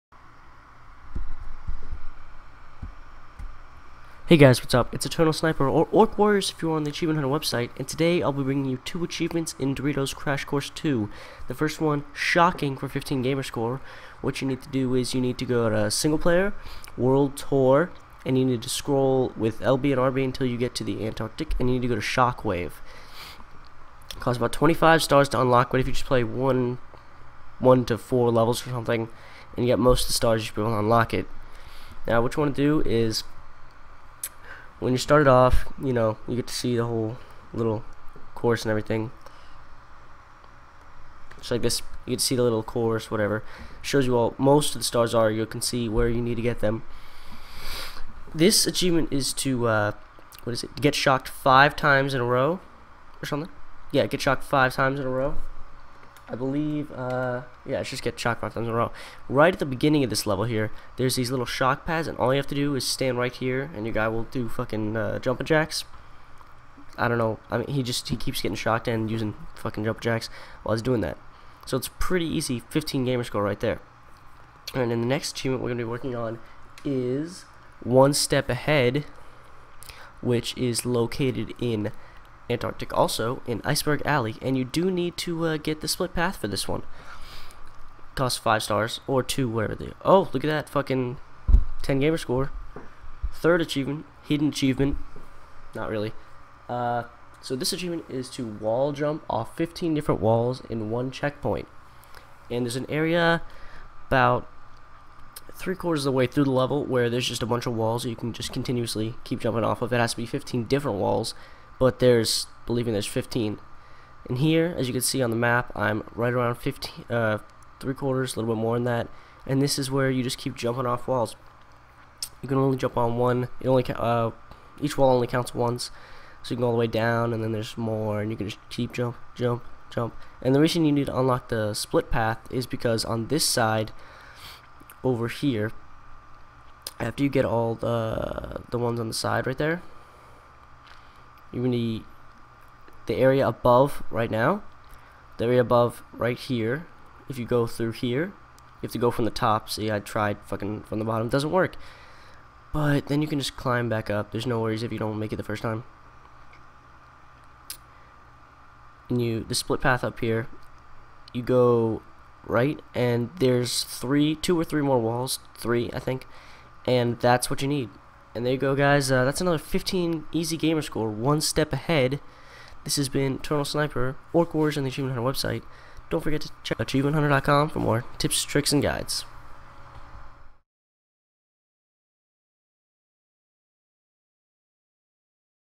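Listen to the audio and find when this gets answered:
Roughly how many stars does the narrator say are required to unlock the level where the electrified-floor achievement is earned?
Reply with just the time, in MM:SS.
00:24.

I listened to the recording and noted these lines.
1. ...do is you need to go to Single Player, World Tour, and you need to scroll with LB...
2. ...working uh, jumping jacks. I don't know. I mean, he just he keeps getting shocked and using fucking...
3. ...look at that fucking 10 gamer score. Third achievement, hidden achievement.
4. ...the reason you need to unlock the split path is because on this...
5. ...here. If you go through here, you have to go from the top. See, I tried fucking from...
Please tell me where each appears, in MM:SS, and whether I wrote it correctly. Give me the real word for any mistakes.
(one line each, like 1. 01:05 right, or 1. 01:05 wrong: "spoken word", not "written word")
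1. 00:14 right
2. 01:04 wrong: "fucking", not "working"
3. 01:30 right
4. 02:10 right
5. 02:26 right.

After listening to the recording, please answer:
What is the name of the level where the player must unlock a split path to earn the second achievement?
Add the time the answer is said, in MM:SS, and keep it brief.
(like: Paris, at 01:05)
Iceberg Alley, at 01:23.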